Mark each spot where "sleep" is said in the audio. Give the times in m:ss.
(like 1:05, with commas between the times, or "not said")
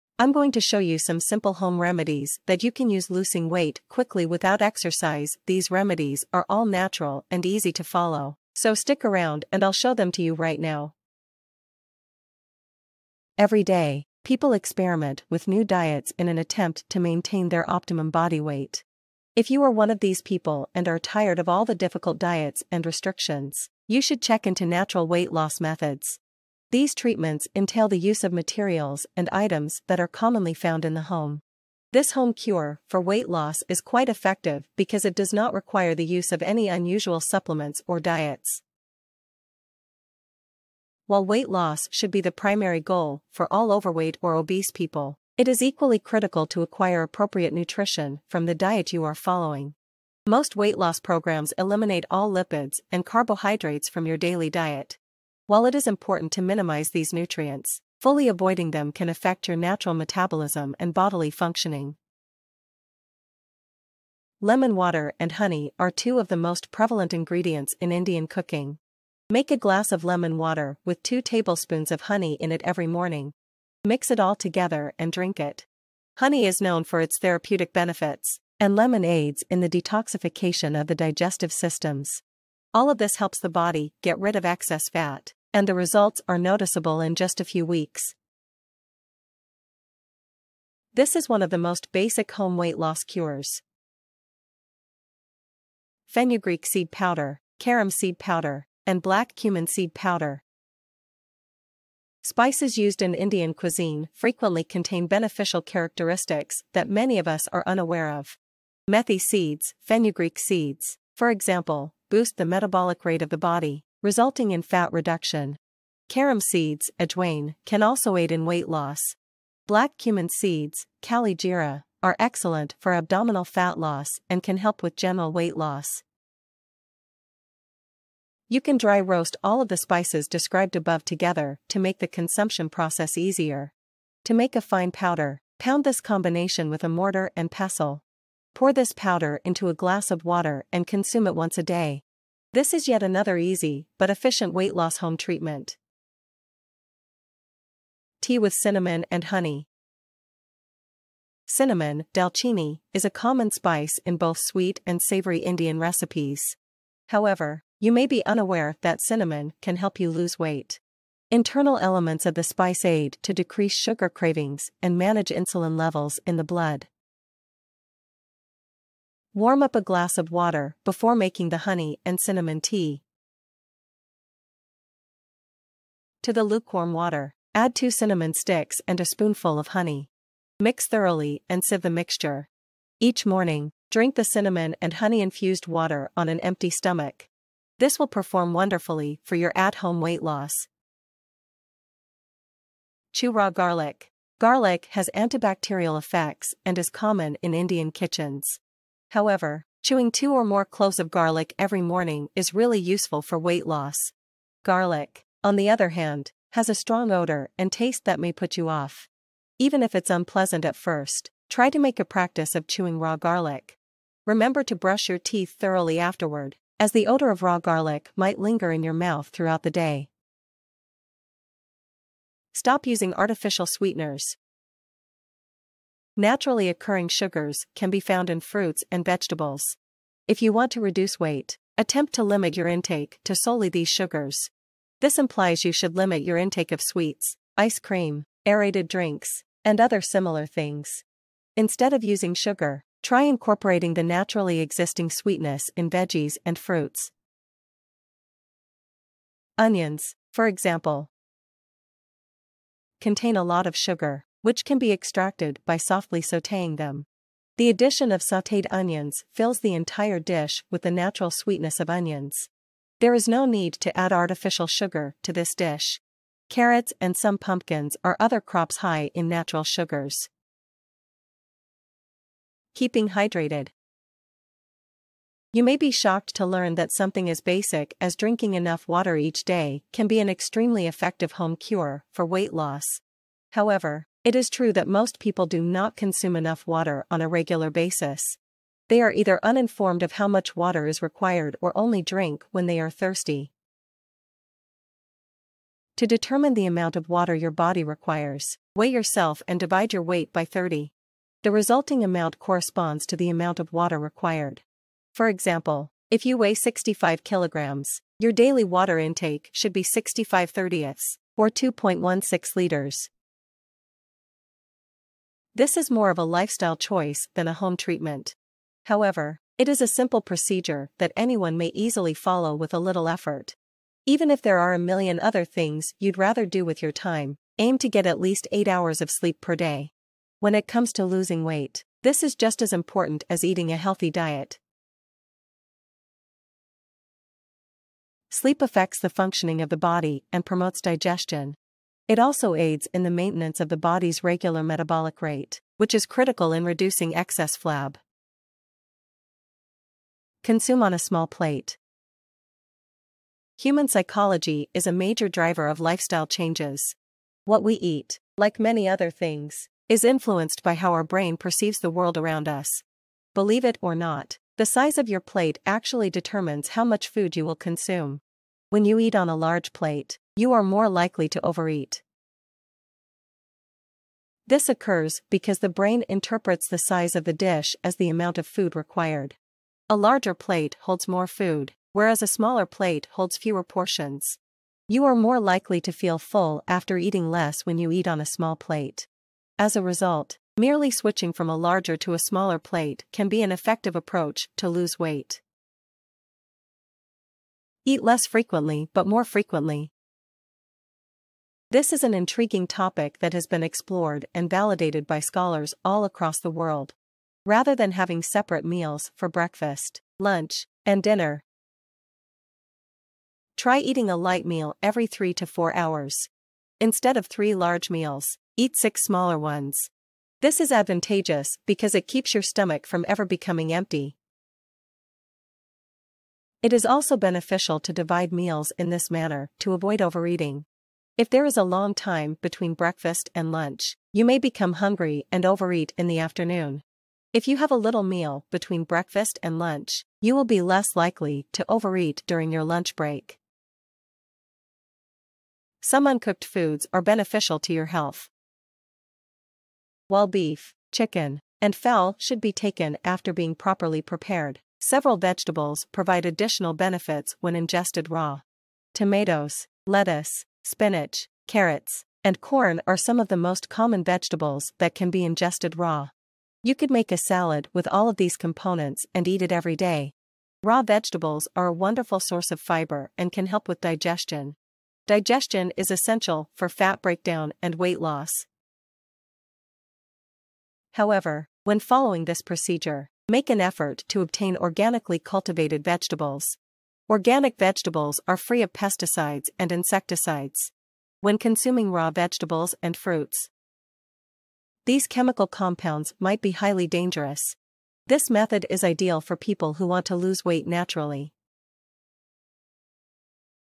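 5:29, 5:38.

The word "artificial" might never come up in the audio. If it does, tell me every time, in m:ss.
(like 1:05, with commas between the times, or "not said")
3:43, 4:24.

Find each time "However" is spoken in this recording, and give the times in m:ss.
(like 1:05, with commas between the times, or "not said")
2:37, 3:19, 4:43, 5:18, 8:00.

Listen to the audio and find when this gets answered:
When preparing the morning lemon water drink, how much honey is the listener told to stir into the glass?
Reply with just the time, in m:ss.
1:11.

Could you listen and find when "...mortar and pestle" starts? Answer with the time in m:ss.
2:16.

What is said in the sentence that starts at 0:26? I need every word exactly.
These treatments entail the use of materials and items that are commonly found in the home.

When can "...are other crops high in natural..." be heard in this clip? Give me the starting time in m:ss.
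4:28.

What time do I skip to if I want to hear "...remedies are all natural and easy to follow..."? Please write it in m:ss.
0:05.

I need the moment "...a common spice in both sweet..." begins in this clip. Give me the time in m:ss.
2:33.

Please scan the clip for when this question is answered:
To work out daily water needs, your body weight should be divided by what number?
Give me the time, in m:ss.
5:00.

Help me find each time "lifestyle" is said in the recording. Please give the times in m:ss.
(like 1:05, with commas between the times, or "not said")
5:16, 5:55.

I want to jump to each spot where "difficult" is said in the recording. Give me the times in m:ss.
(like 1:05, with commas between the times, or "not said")
0:21.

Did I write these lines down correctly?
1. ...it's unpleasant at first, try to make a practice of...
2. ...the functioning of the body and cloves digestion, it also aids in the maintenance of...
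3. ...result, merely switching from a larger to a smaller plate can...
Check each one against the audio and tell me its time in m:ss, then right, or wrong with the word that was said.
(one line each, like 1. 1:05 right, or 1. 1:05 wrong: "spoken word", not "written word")
1. 3:29 right
2. 5:38 wrong: "promotes", not "cloves"
3. 6:29 right.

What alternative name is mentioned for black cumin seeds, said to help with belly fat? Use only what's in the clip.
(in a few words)
kalijira.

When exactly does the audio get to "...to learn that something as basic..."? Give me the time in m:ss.
4:36.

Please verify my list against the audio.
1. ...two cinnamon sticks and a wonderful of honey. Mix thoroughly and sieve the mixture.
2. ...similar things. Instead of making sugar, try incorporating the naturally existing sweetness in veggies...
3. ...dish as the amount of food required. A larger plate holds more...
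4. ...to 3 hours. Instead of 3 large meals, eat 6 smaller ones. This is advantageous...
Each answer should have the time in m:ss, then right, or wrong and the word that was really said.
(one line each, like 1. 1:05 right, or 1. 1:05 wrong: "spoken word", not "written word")
1. 2:57 wrong: "spoonful", not "wonderful"
2. 4:00 wrong: "using", not "making"
3. 6:17 right
4. 6:55 wrong: "4", not "3".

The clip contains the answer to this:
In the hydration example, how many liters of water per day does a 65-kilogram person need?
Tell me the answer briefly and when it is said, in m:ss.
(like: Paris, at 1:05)
2.16 liters, at 5:11.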